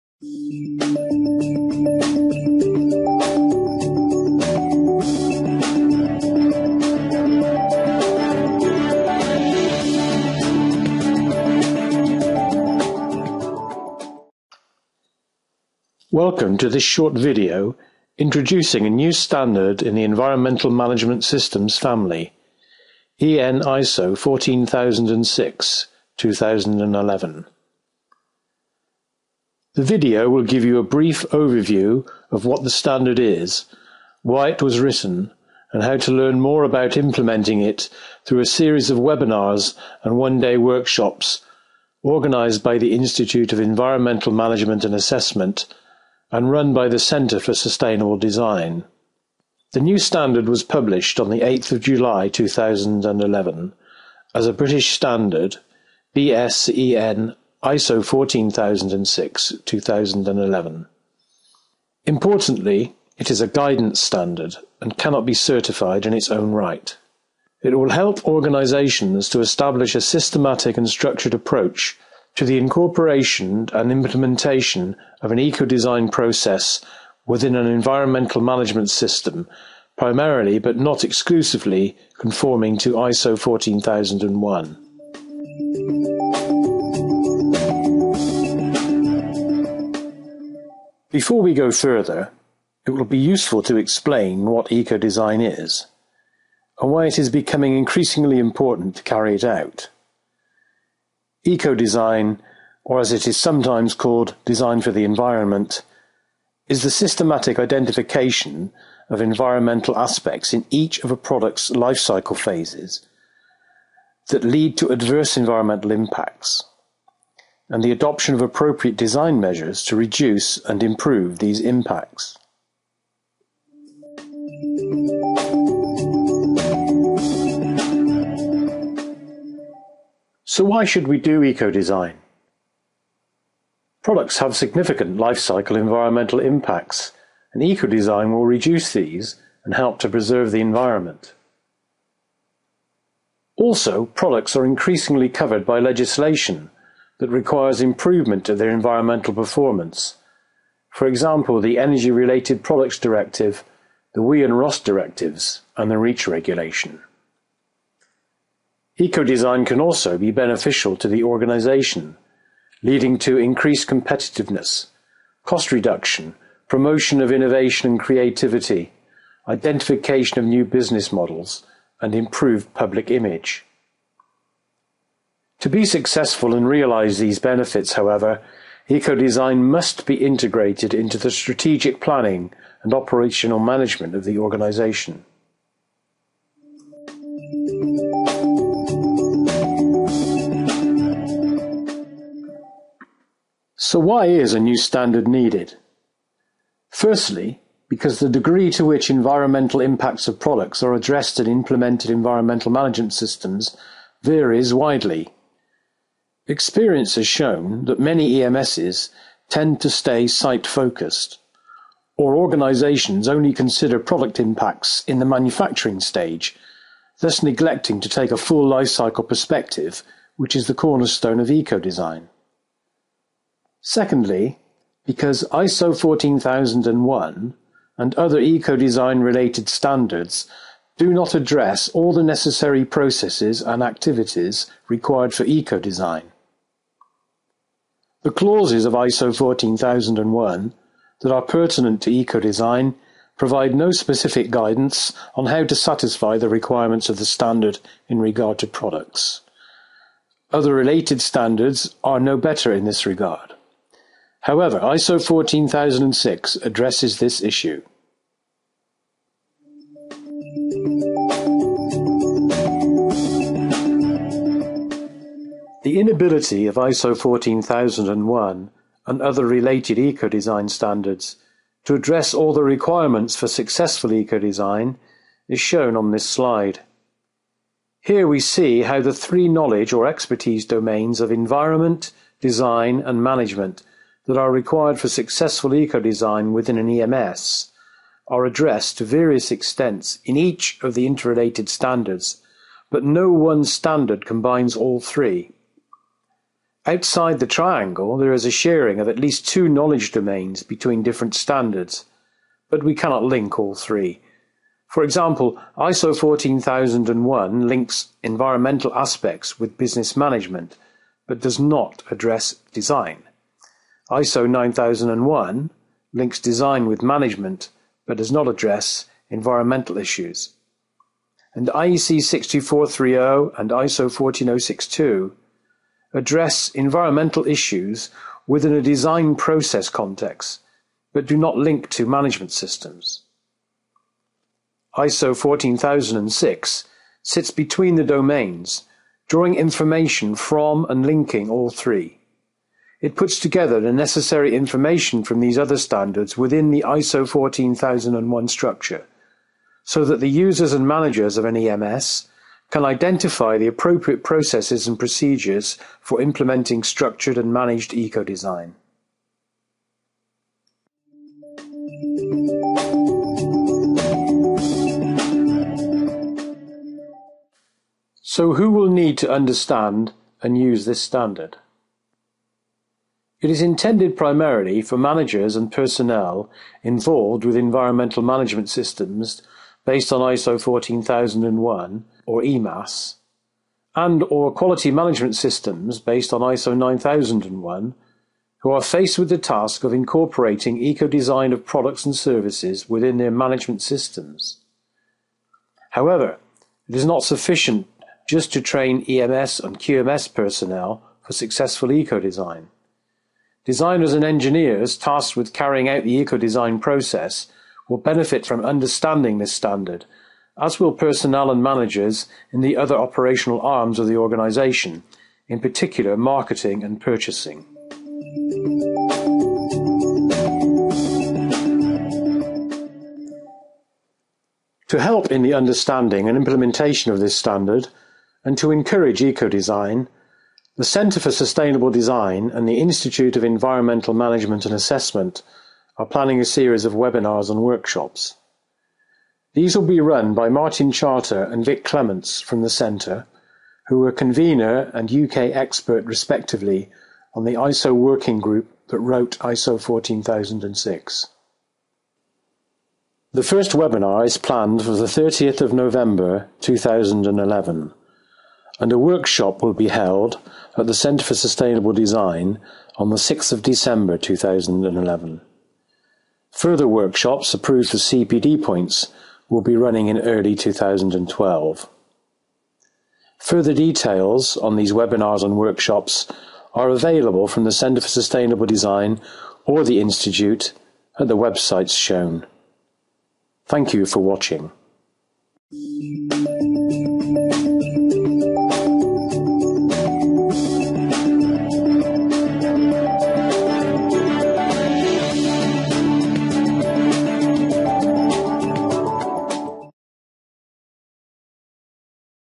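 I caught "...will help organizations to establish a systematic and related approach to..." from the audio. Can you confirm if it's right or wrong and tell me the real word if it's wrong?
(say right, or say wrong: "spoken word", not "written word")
wrong: "structured", not "related".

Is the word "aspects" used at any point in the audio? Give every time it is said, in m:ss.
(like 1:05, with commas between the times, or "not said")
1:49, 5:08.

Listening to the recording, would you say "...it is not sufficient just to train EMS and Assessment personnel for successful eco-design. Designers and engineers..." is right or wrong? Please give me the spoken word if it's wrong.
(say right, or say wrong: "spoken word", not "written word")
wrong: "QMS", not "Assessment".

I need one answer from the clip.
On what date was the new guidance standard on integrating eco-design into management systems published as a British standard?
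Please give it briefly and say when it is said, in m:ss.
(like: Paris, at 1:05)
8 July 2011, at 0:51.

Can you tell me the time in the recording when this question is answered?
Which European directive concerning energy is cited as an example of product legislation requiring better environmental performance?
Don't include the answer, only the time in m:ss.
2:31.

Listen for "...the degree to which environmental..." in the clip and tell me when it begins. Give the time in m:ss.
3:18.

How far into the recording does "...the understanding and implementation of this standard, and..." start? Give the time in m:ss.
7:05.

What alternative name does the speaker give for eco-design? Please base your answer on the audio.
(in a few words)
design for the environment.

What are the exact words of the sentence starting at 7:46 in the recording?
Further workshops approved for CPD points will be running in early 2012.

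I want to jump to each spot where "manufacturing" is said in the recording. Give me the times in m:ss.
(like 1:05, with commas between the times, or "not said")
3:35.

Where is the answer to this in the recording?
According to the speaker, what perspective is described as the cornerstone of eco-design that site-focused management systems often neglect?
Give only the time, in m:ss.
3:38.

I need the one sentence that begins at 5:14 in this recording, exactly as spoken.
ISO 9001 links design with management, but does not address environmental issues.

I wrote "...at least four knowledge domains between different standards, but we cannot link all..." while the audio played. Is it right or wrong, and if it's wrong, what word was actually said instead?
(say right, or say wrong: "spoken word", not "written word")
wrong: "two", not "four".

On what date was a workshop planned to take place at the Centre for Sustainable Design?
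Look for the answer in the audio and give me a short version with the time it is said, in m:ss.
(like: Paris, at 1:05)
6 December 2011, at 7:43.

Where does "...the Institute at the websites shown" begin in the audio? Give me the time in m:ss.
7:59.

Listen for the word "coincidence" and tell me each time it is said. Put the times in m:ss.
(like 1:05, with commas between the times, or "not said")
not said.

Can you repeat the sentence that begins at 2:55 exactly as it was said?
To be successful and realize these benefits, however, eco-design must be integrated into the strategic planning and operational management of the organization.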